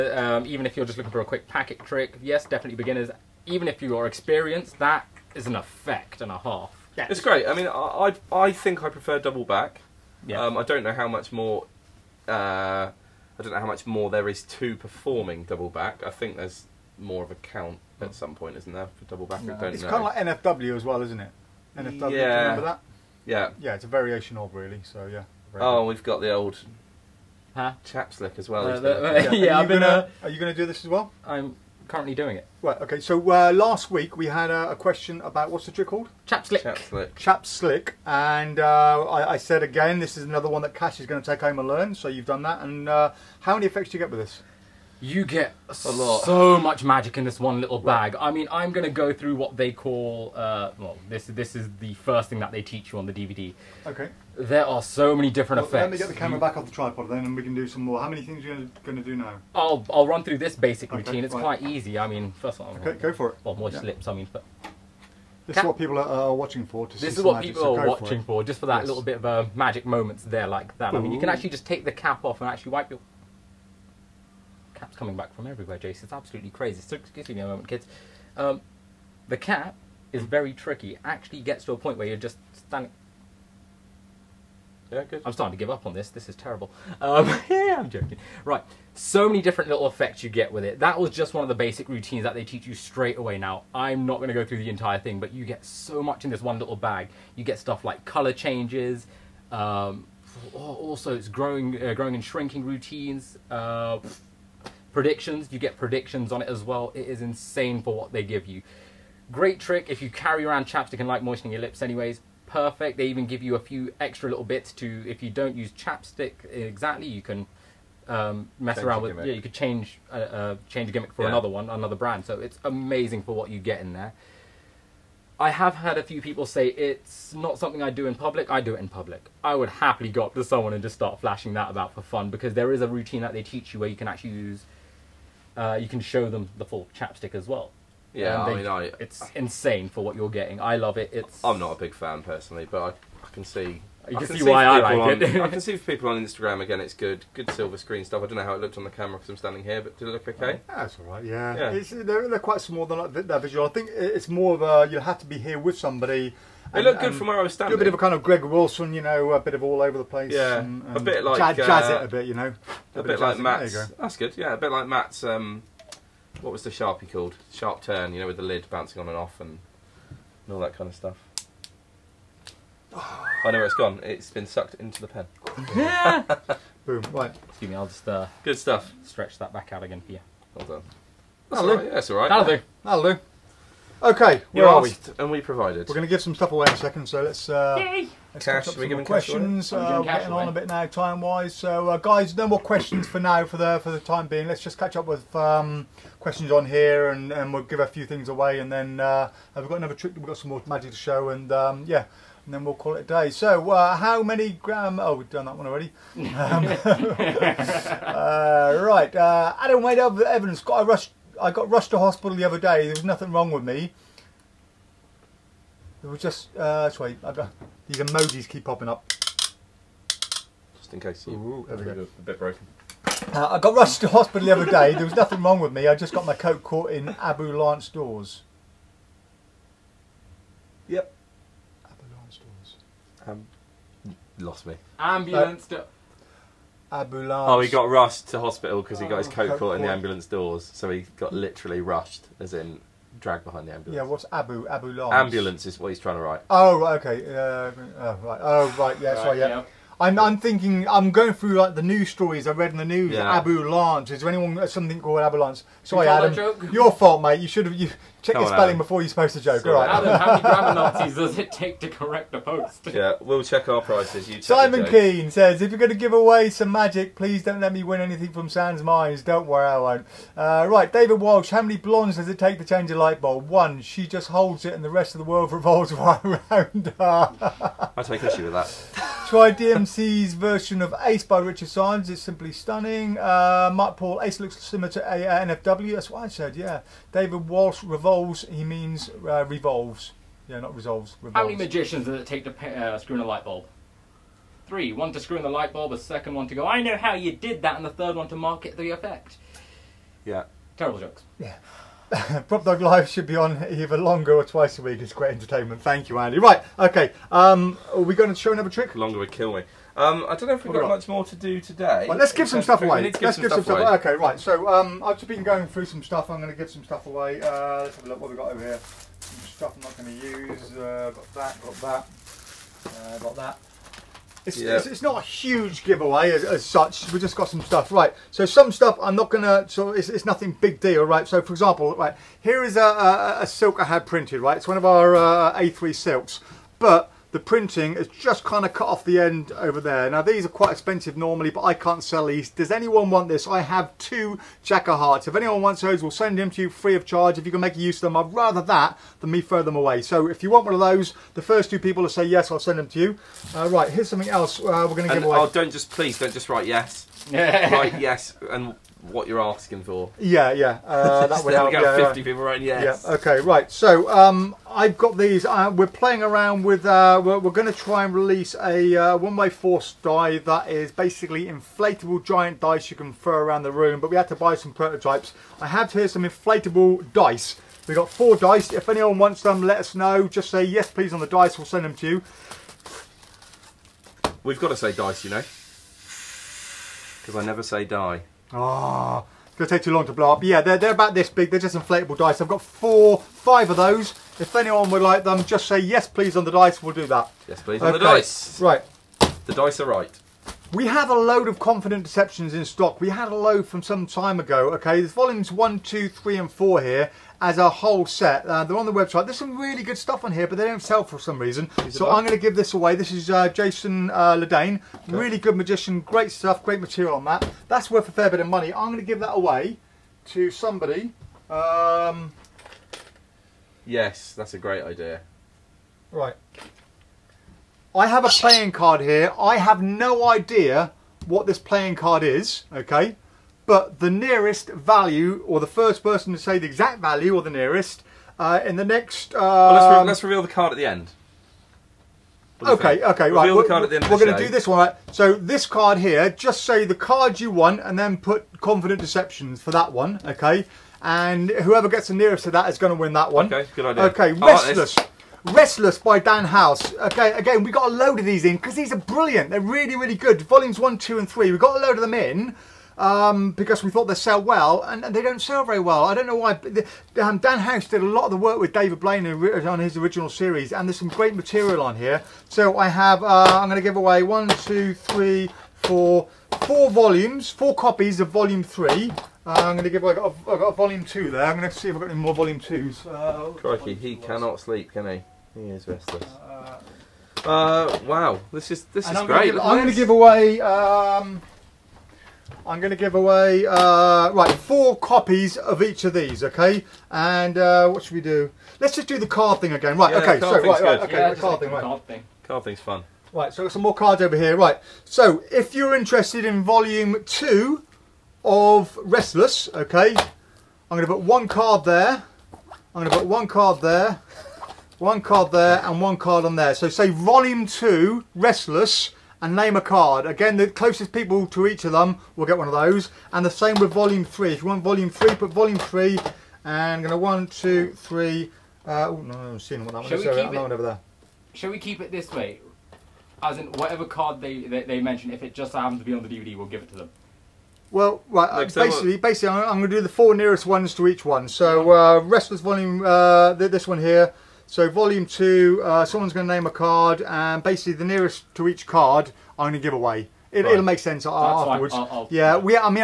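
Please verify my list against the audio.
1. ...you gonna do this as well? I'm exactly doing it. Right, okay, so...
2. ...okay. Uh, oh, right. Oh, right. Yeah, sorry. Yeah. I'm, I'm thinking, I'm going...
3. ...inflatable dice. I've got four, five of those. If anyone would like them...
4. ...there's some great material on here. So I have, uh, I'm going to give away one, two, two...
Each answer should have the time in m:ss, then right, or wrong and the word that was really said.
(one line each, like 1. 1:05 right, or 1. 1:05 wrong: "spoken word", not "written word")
1. 0:30 wrong: "currently", not "exactly"
2. 4:07 right
3. 6:31 right
4. 7:50 wrong: "three", not "two".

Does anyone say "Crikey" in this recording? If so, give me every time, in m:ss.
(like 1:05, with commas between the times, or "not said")
8:03.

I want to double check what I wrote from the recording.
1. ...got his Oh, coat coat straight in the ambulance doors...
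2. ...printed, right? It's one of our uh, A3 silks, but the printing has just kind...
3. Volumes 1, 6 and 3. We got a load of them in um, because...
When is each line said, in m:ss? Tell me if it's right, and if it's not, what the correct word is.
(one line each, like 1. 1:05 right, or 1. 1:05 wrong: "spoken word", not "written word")
1. 3:59 wrong: "caught", not "straight"
2. 5:34 right
3. 7:40 wrong: "2", not "6".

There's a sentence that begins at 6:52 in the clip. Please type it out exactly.
This is uh, Jason uh, Okay.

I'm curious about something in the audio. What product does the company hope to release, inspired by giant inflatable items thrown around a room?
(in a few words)
One-way force die.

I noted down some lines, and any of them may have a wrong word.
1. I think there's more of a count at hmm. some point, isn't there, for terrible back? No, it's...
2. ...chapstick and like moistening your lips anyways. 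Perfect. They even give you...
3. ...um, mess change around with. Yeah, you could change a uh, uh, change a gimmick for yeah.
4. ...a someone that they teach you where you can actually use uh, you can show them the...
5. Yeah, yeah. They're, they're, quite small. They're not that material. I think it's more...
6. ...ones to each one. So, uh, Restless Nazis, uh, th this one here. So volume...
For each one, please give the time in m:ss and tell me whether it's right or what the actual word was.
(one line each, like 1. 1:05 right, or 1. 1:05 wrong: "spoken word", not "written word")
1. 0:16 wrong: "double", not "terrible"
2. 1:50 right
3. 1:58 right
4. 2:12 wrong: "routine", not "someone"
5. 2:31 wrong: "visual", not "material"
6. 9:00 wrong: "Volume", not "Nazis".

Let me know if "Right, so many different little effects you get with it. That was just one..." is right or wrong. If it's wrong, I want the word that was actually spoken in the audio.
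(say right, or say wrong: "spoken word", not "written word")
right.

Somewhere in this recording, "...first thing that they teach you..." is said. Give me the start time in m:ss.
0:51.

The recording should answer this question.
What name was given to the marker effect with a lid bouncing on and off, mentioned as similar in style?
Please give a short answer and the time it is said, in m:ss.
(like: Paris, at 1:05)
Sharp turn, at 2:47.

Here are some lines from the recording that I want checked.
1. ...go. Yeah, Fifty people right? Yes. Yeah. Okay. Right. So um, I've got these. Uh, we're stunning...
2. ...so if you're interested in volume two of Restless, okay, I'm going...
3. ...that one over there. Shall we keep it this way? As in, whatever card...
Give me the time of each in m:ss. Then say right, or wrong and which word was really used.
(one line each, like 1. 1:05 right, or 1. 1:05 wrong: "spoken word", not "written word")
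1. 6:01 wrong: "playing", not "stunning"
2. 8:25 right
3. 8:50 right.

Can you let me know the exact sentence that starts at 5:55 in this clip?
Oh, don't just, please, don't just write yes.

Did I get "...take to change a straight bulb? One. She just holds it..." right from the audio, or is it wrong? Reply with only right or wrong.
wrong.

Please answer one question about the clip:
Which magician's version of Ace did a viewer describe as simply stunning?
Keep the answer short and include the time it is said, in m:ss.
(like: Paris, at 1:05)
Richard Sanders, at 4:41.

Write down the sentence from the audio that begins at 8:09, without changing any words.
Gonna give, I'm going to give away.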